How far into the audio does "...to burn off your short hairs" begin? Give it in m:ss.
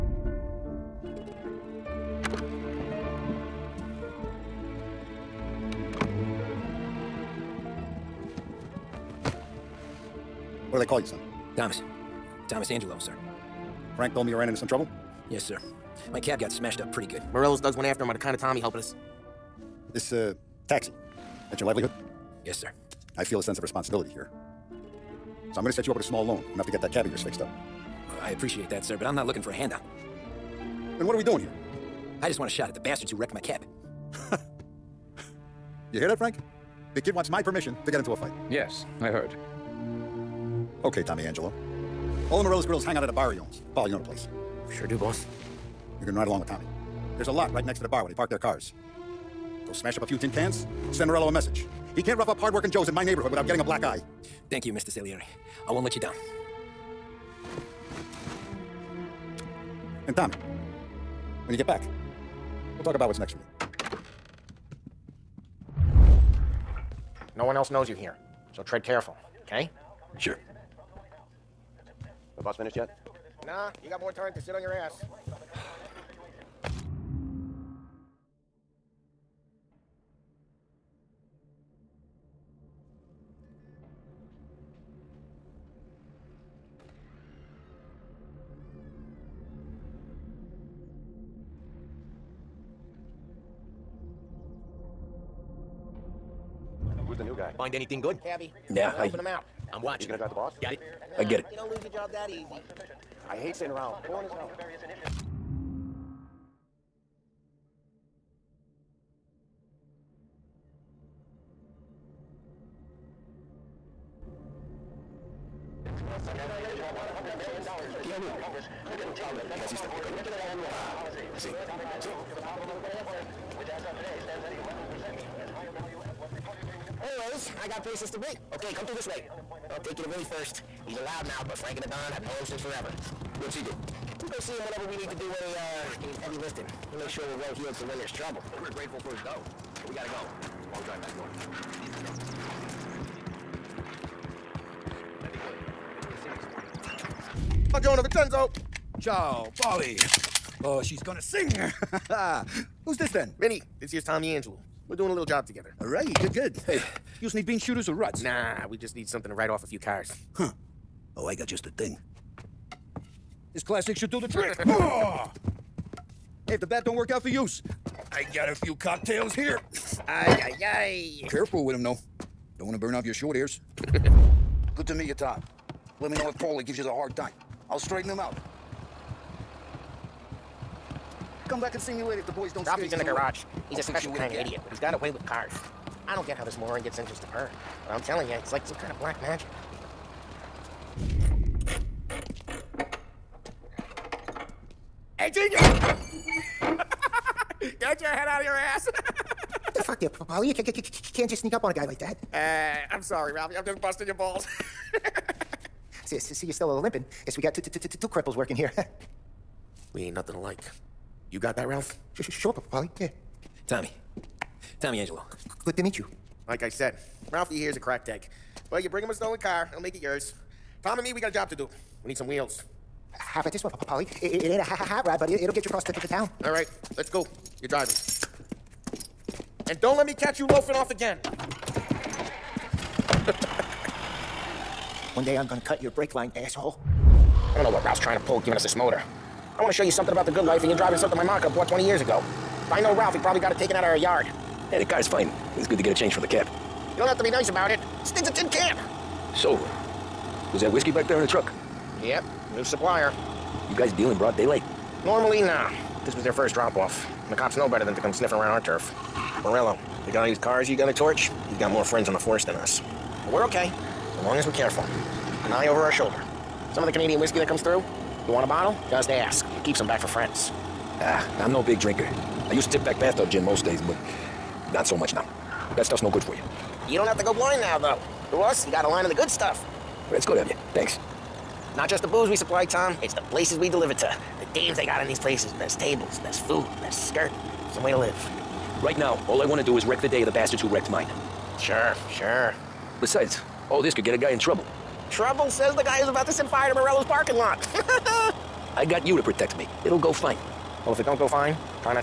2:52.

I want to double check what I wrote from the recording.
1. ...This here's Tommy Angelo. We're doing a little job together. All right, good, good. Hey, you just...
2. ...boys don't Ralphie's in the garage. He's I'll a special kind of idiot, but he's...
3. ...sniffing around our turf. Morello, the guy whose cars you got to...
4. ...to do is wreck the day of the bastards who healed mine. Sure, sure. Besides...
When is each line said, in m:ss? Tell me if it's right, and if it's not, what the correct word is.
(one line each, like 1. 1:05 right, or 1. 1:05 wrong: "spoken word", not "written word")
1. 2:33 right
2. 3:02 right
3. 4:18 right
4. 4:49 wrong: "wrecked", not "healed".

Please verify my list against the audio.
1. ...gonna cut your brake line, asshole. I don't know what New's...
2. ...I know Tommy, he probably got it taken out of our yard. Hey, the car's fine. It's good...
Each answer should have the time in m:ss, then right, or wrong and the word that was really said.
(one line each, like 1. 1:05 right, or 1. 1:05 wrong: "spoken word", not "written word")
1. 3:55 wrong: "Ralph", not "New"
2. 4:02 wrong: "Ralph", not "Tommy".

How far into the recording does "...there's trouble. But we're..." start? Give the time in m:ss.
2:17.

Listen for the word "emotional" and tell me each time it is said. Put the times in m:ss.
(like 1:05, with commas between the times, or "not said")
not said.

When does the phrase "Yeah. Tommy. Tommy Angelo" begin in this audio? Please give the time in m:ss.
3:32.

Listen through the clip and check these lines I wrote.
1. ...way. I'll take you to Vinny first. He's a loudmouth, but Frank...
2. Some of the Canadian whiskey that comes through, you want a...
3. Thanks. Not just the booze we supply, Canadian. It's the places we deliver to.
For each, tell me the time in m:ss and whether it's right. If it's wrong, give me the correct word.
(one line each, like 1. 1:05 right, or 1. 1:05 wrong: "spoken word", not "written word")
1. 2:09 right
2. 4:26 right
3. 4:40 wrong: "Tom", not "Canadian".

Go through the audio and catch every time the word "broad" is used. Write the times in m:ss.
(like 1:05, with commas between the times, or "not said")
4:14.